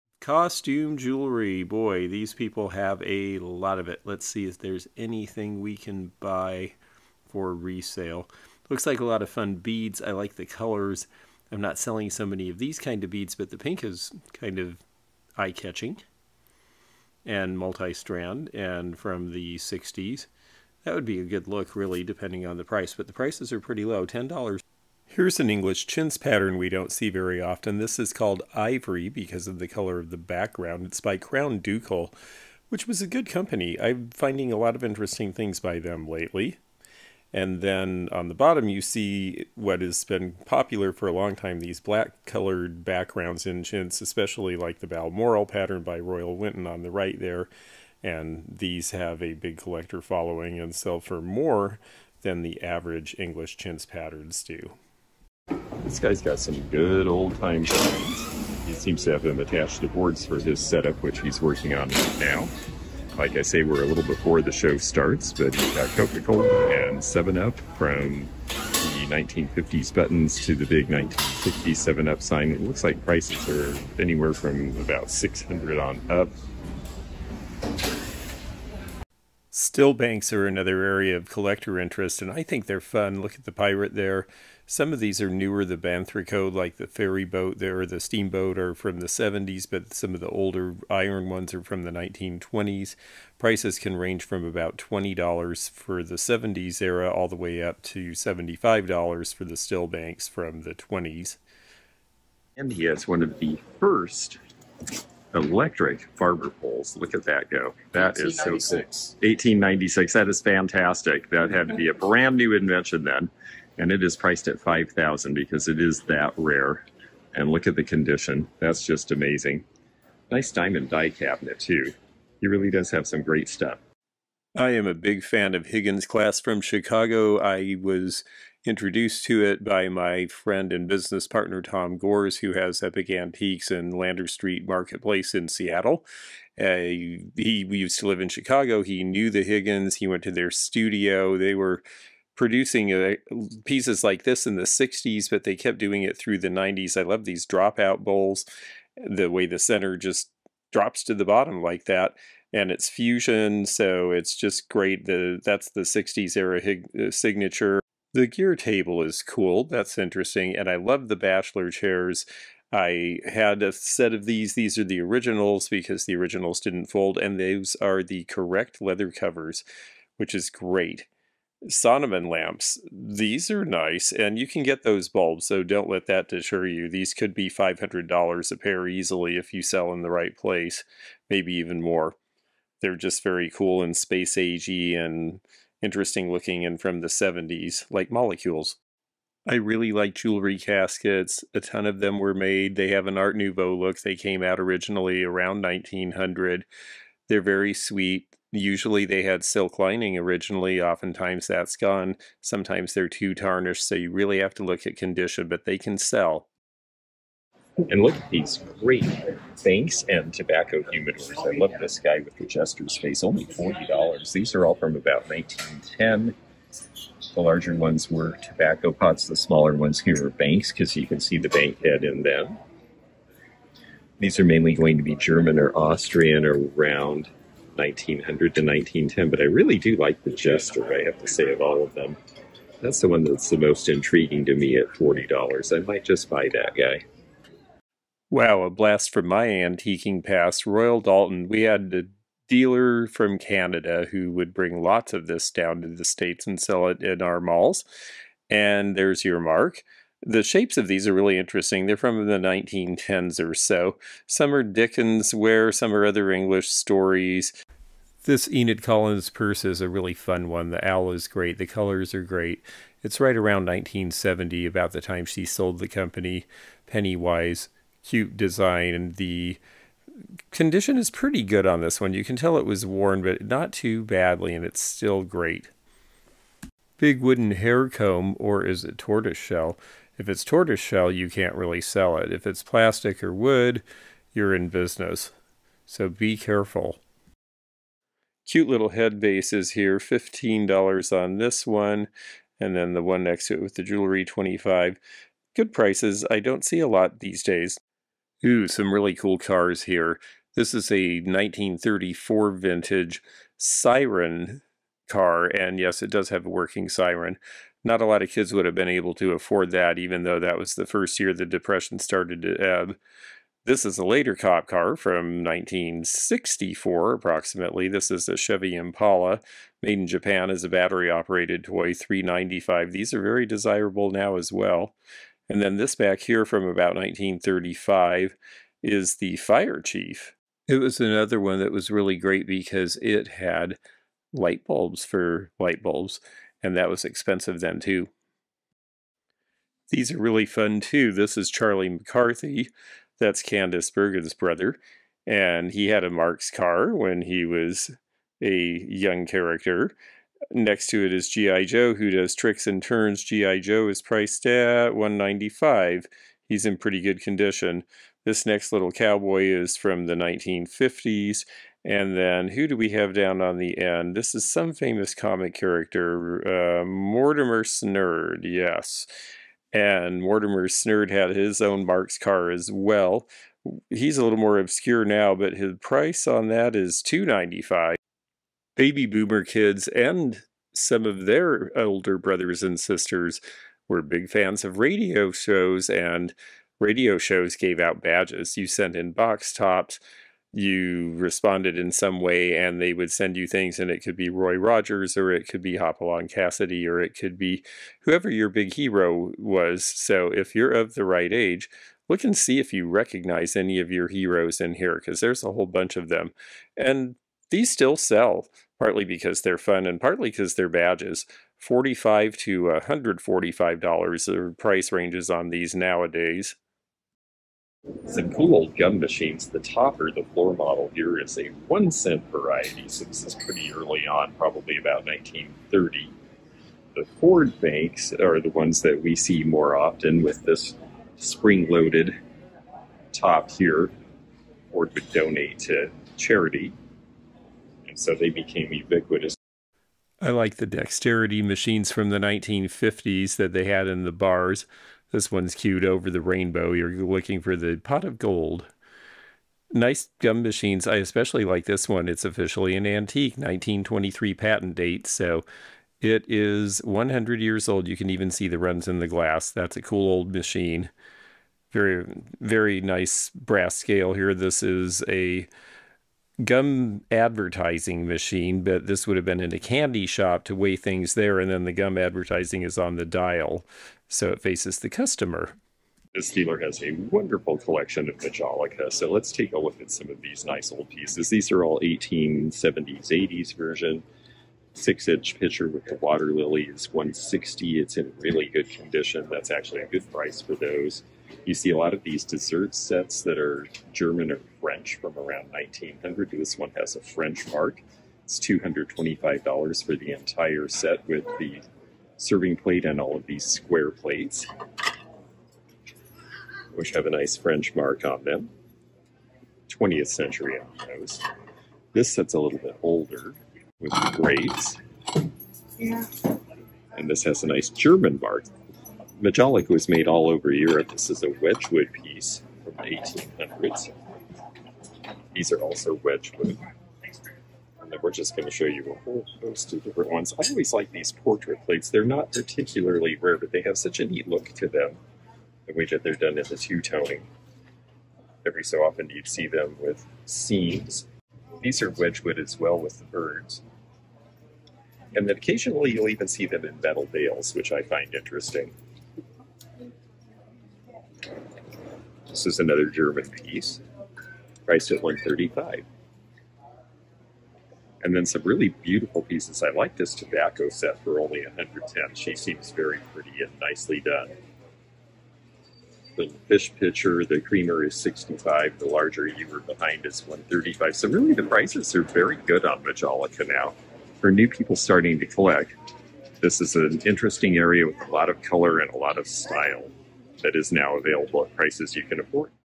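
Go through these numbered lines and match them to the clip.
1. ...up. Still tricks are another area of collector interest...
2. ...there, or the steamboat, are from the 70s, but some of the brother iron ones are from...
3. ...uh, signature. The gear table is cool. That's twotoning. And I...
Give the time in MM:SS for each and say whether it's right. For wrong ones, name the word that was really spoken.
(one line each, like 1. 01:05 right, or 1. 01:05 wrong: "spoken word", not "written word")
1. 01:16 wrong: "banks", not "tricks"
2. 01:27 wrong: "older", not "brother"
3. 02:37 wrong: "interesting", not "twotoning".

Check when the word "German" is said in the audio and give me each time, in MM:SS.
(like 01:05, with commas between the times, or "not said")
03:45, 08:13, 08:37, 09:12.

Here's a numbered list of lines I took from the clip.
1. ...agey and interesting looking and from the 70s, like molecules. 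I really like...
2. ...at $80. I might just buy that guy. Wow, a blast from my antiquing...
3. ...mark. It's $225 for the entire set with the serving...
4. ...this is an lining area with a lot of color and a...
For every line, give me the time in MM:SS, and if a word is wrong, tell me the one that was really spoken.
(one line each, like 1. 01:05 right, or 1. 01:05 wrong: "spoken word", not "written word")
1. 03:04 right
2. 03:54 wrong: "40", not "80"
3. 08:17 right
4. 09:36 wrong: "interesting", not "lining".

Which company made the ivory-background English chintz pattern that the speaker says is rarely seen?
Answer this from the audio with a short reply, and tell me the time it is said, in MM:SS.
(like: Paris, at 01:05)
Crown Ducal, at 00:31.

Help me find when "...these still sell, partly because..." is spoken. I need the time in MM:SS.
06:47.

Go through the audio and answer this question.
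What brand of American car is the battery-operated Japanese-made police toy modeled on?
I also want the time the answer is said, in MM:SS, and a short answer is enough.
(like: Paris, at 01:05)
Chevy Impala, at 05:18.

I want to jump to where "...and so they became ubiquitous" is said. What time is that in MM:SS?
07:17.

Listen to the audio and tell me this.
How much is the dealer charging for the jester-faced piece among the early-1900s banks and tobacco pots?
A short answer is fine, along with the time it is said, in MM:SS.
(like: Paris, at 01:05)
$40, at 03:33.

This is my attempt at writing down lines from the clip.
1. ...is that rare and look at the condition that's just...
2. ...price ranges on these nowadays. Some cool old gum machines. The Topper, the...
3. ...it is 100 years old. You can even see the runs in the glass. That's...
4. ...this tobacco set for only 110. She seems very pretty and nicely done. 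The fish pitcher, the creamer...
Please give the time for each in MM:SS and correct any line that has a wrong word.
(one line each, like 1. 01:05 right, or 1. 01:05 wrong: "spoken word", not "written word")
1. 01:55 right
2. 06:54 right
3. 07:35 right
4. 09:19 right.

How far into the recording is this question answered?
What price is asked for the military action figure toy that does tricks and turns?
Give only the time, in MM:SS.
05:54.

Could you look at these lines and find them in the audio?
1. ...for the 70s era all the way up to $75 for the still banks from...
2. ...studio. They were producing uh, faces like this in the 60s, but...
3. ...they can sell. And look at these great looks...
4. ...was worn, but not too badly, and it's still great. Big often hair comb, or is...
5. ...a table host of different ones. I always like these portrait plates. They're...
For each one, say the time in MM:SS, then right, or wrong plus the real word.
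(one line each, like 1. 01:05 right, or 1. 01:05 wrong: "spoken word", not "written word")
1. 01:35 right
2. 02:20 wrong: "pieces", not "faces"
3. 03:25 wrong: "banks", not "looks"
4. 04:32 wrong: "wooden", not "often"
5. 08:48 wrong: "whole", not "table".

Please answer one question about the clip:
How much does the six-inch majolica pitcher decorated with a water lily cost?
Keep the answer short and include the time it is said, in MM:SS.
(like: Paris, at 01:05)
160, at 08:06.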